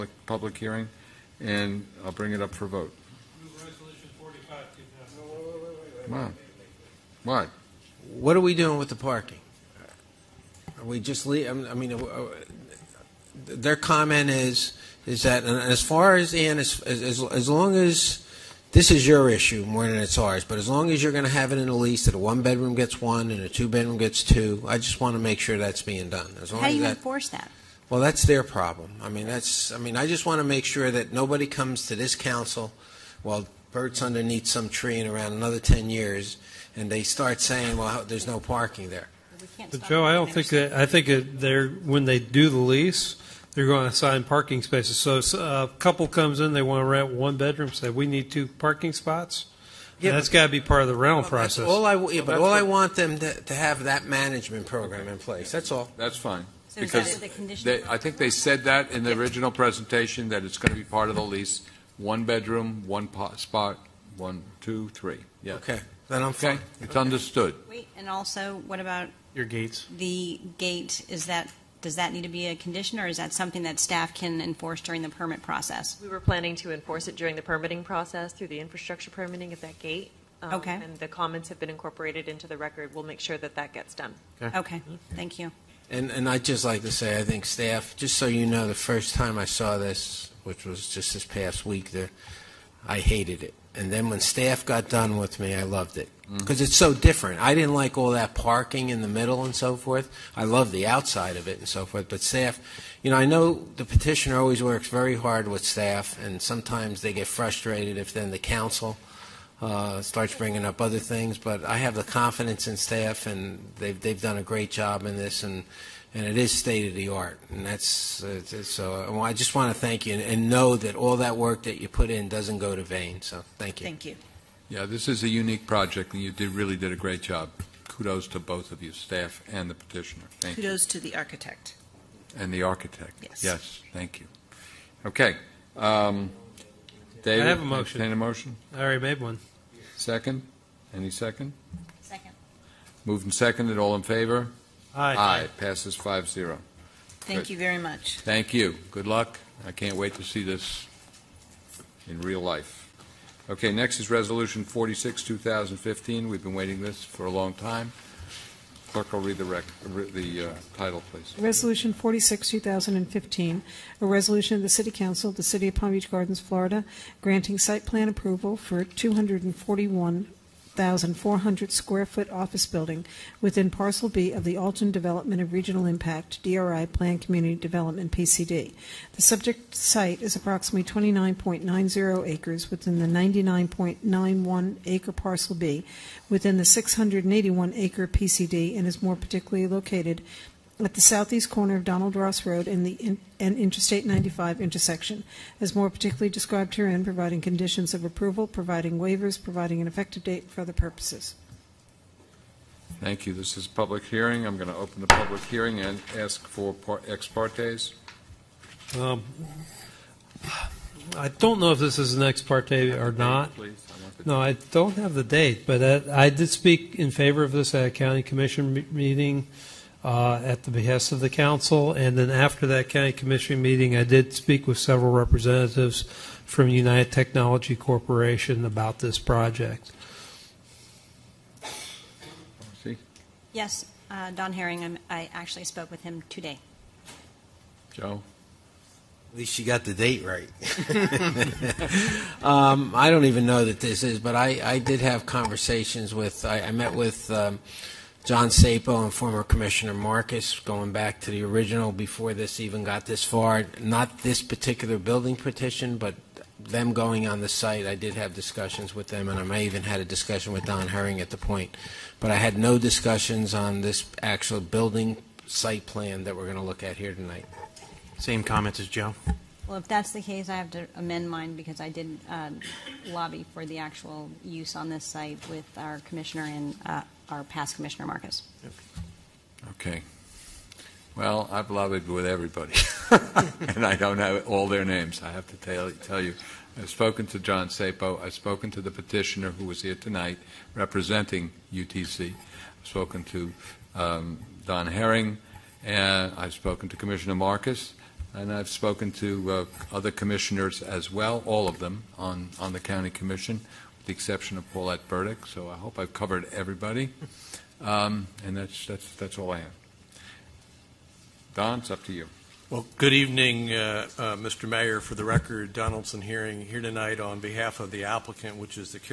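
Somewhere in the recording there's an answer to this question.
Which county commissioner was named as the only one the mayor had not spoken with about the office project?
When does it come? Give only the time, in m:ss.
5:04.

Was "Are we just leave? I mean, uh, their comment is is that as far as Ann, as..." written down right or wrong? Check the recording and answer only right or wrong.
right.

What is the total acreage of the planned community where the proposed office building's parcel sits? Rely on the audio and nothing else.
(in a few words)
681 acres.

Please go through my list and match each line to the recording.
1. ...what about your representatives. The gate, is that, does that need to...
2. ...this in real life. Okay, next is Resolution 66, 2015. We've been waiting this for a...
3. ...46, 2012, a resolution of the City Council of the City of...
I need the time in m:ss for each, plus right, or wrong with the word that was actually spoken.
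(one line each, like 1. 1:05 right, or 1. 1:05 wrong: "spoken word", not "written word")
1. 1:08 wrong: "gates", not "representatives"
2. 2:30 wrong: "46", not "66"
3. 2:41 wrong: "2015", not "2012".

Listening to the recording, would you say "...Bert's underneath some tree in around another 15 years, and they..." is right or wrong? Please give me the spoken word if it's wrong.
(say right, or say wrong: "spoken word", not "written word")
wrong: "10", not "15".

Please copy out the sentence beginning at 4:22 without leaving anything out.
But I had no discussions on this actual building site plan that we're going to look at here tonight.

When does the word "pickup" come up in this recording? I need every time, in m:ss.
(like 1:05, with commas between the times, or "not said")
not said.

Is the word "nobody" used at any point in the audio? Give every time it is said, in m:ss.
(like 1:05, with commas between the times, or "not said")
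0:31.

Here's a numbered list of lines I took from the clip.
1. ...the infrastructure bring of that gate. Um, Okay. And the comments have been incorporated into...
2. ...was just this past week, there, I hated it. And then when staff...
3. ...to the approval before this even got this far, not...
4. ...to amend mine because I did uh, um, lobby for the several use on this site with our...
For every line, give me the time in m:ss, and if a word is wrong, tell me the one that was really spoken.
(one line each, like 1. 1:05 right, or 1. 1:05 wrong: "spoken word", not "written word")
1. 1:18 wrong: "permitting", not "bring"
2. 1:30 right
3. 4:11 wrong: "original", not "approval"
4. 4:30 wrong: "actual", not "several".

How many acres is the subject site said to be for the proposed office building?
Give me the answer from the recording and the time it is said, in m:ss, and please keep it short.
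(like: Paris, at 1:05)
29.90 acres, at 3:01.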